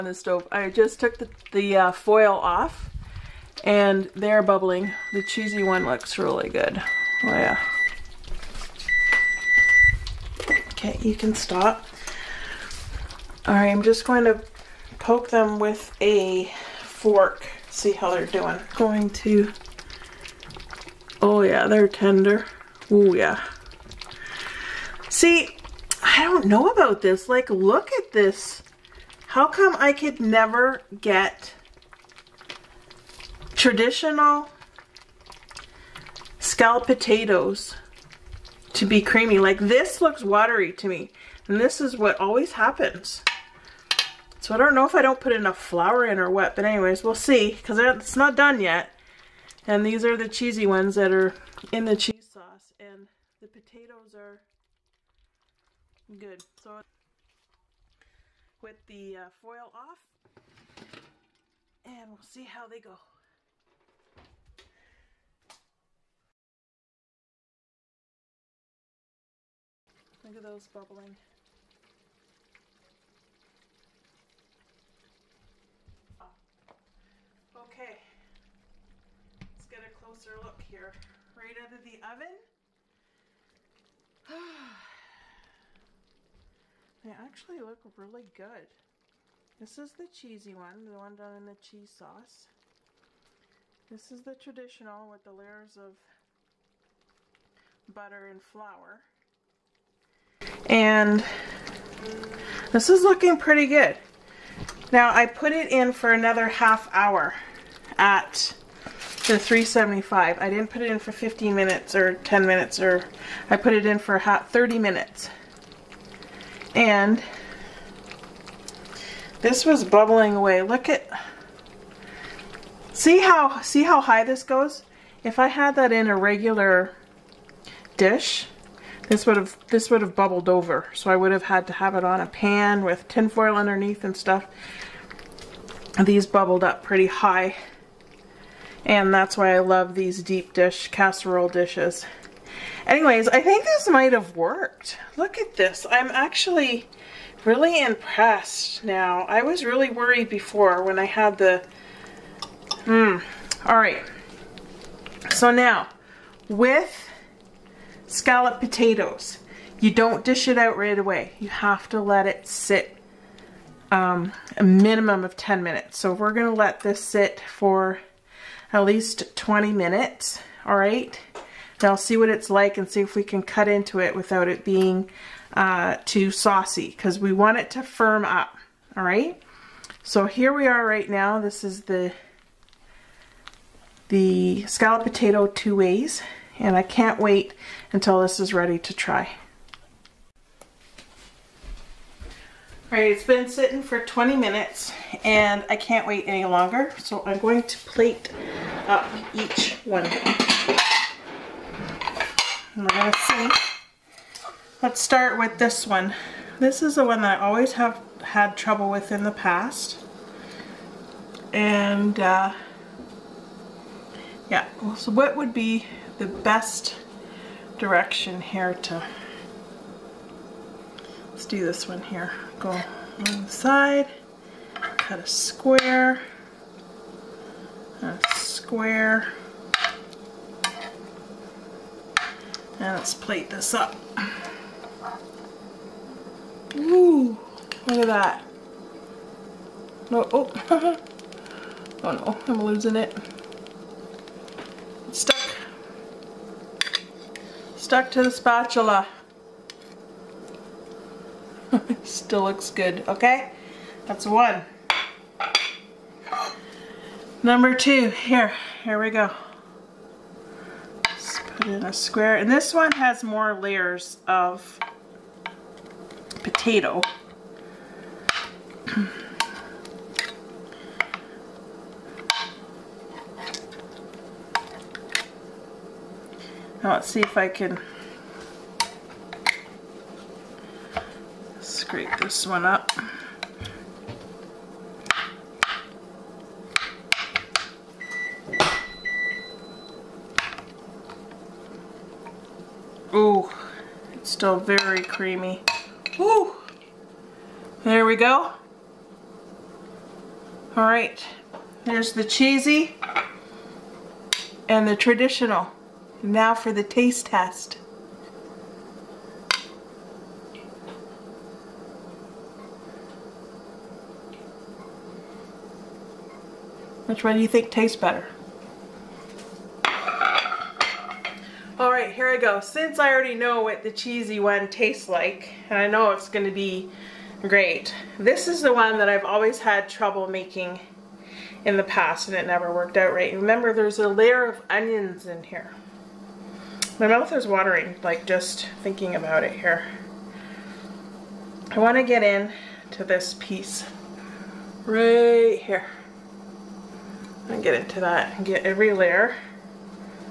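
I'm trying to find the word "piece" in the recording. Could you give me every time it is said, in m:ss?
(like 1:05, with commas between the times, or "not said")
5:43.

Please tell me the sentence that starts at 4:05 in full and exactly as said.
It's stuck stuck to the spatula.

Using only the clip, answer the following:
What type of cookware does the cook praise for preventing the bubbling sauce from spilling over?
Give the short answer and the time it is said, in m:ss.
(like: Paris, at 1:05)
deep dish casserole dishes, at 2:20.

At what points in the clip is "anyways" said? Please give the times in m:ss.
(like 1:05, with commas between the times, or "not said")
0:46, 2:22.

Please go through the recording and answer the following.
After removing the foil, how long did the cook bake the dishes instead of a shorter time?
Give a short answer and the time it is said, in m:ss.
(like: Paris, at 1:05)
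30 minutes, at 1:54.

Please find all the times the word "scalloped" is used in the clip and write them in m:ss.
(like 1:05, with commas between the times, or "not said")
0:36, 2:38, 3:04.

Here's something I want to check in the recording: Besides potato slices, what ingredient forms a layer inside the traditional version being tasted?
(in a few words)
onions.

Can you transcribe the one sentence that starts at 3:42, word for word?
Go on the side, cut a square, a square, and let's plate this up.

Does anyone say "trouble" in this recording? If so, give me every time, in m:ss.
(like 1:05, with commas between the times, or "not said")
3:28, 5:29.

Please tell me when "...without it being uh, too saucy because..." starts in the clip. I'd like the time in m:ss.
2:54.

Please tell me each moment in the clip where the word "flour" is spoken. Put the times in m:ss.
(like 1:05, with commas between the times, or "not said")
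0:45, 1:38.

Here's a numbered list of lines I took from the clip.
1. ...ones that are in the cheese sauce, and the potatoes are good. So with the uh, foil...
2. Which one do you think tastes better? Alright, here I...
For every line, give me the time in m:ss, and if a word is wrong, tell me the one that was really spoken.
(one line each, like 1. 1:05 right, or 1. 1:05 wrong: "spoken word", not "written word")
1. 0:50 right
2. 5:17 right.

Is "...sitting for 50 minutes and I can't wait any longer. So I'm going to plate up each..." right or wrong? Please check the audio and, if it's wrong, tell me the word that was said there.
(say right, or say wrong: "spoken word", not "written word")
wrong: "20", not "50".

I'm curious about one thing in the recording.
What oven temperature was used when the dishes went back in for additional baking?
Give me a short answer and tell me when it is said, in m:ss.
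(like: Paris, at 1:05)
375, at 1:49.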